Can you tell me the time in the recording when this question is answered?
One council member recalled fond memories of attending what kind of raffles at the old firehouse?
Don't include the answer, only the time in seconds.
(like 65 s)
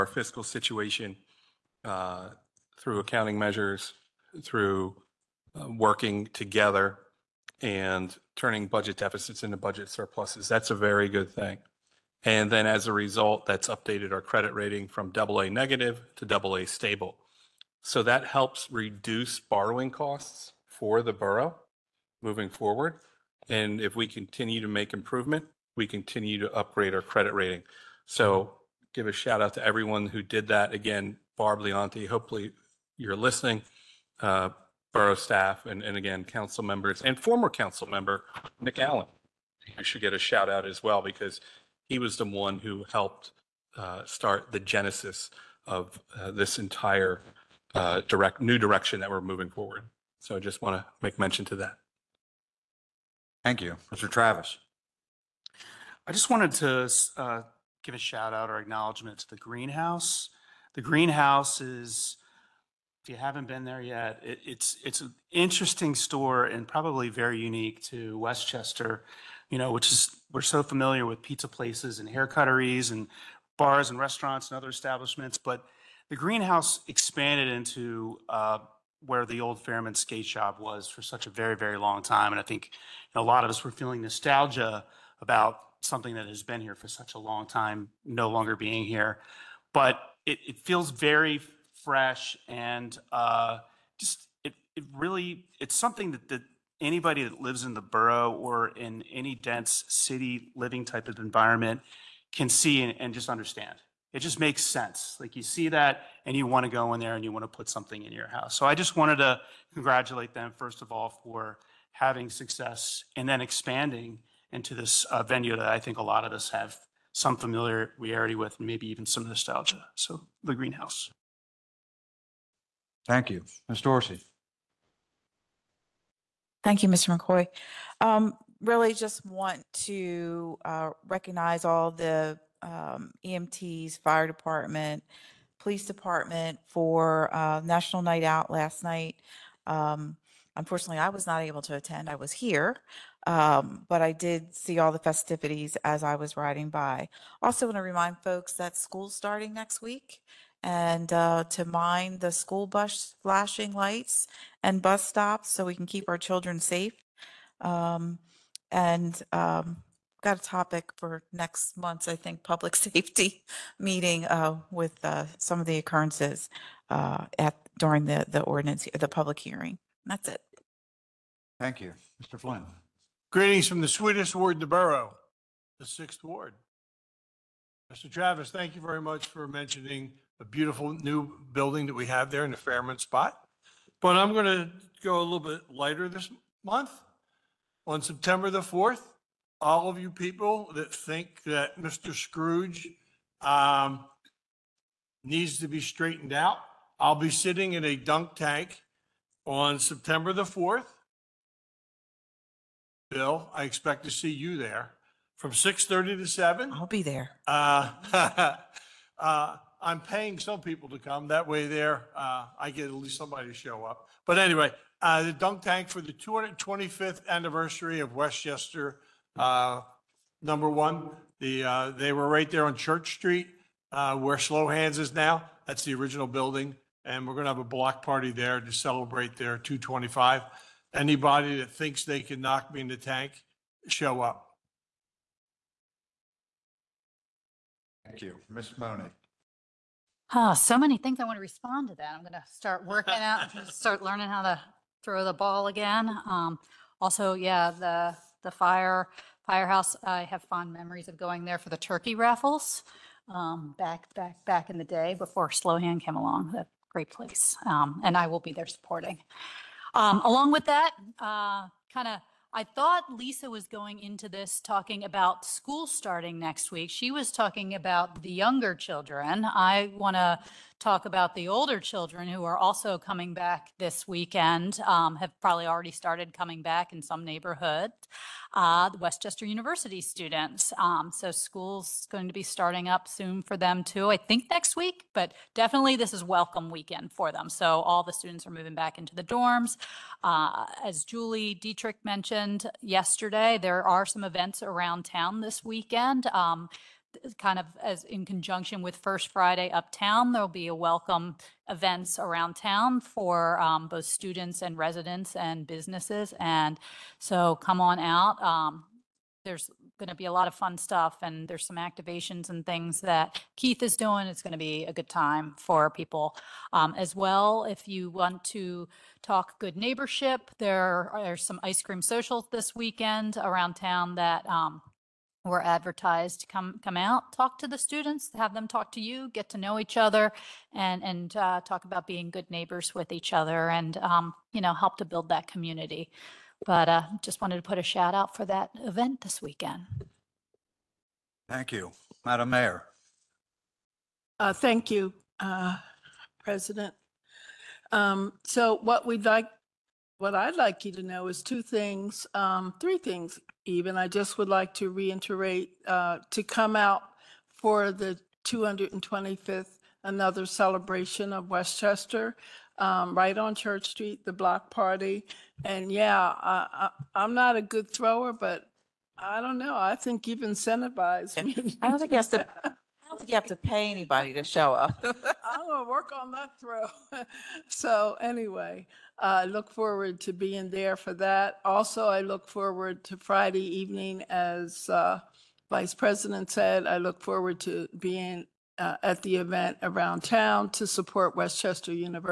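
251 s.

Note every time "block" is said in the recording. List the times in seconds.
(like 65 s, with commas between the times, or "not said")
227 s, 364 s.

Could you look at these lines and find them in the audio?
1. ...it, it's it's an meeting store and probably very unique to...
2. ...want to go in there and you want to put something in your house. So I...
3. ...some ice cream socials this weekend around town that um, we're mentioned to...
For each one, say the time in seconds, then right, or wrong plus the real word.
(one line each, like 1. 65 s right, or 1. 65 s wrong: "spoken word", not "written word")
1. 64 s wrong: "interesting", not "meeting"
2. 106 s right
3. 321 s wrong: "advertised", not "mentioned".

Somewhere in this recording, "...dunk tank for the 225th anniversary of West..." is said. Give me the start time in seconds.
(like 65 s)
215 s.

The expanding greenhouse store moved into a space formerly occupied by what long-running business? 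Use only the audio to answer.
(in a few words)
Fairman skate shop.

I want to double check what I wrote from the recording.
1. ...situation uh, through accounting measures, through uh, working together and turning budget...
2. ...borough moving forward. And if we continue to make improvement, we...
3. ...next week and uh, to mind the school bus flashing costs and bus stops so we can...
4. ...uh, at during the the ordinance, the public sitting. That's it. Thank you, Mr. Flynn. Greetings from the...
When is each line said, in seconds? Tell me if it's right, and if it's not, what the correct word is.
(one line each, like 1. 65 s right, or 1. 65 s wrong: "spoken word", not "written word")
1. 0 s right
2. 21 s right
3. 149 s wrong: "lights", not "costs"
4. 166 s wrong: "hearing", not "sitting".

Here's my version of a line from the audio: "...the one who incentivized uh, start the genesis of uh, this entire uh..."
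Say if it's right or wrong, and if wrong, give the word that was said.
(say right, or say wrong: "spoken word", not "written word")
wrong: "helped", not "incentivized".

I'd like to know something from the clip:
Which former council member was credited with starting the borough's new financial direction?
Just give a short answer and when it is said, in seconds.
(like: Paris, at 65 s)
Nick Allen, at 38 s.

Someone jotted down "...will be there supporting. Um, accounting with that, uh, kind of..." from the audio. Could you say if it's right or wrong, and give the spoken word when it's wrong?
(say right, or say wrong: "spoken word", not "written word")
wrong: "along", not "accounting".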